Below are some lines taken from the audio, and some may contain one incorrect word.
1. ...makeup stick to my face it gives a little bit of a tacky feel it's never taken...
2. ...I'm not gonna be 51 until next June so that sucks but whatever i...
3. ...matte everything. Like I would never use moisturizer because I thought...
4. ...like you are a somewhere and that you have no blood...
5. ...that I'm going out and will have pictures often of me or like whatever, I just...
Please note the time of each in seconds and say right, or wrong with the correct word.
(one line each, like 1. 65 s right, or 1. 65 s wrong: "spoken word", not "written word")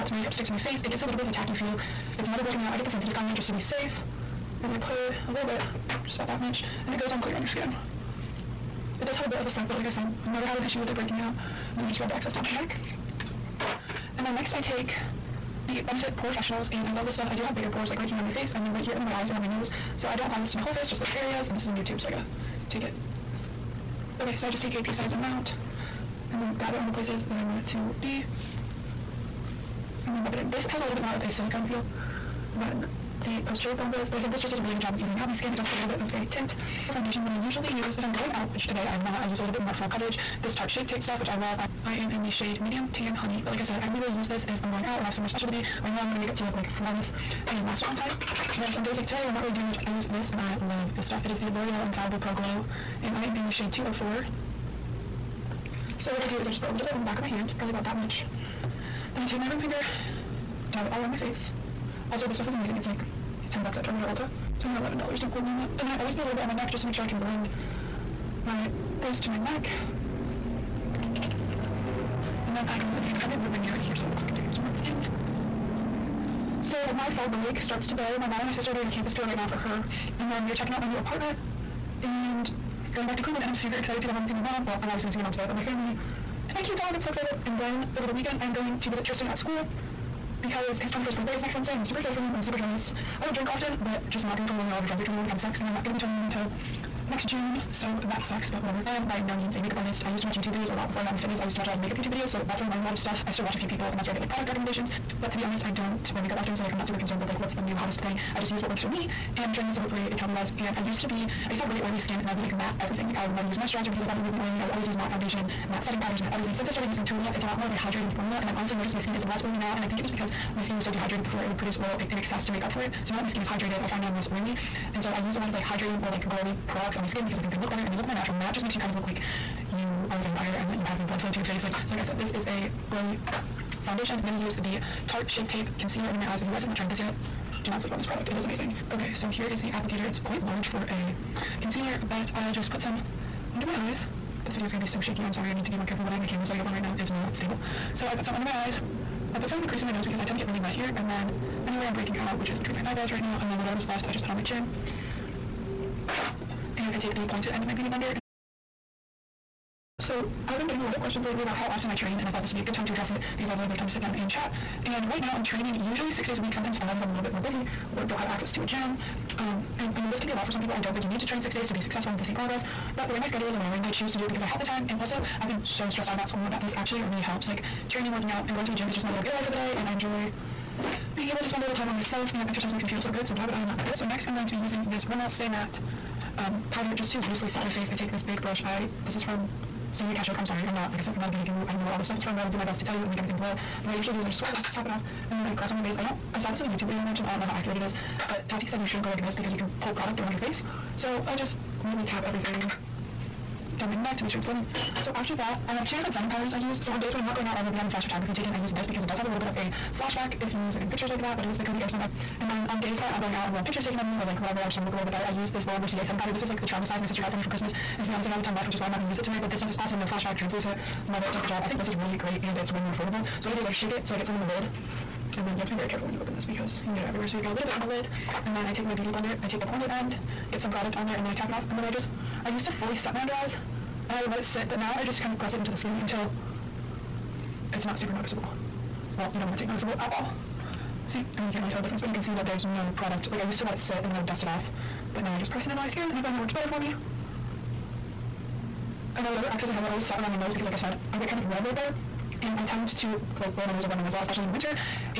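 1. 0 s wrong: "broken", not "taken"
2. 95 s wrong: "21", not "51"
3. 112 s right
4. 129 s wrong: "vampire", not "somewhere"
5. 213 s wrong: "taken", not "often".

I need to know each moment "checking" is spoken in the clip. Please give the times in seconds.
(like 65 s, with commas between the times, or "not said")
80 s.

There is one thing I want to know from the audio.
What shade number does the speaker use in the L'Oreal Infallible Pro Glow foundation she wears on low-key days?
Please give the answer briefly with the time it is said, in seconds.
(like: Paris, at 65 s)
204, at 53 s.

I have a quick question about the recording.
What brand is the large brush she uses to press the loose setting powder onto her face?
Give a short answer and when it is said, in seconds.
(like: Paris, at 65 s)
Sonia Kashuk, at 189 s.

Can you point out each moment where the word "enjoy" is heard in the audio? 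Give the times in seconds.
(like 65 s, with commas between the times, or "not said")
179 s.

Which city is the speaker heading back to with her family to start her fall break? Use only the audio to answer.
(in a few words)
Cleveland.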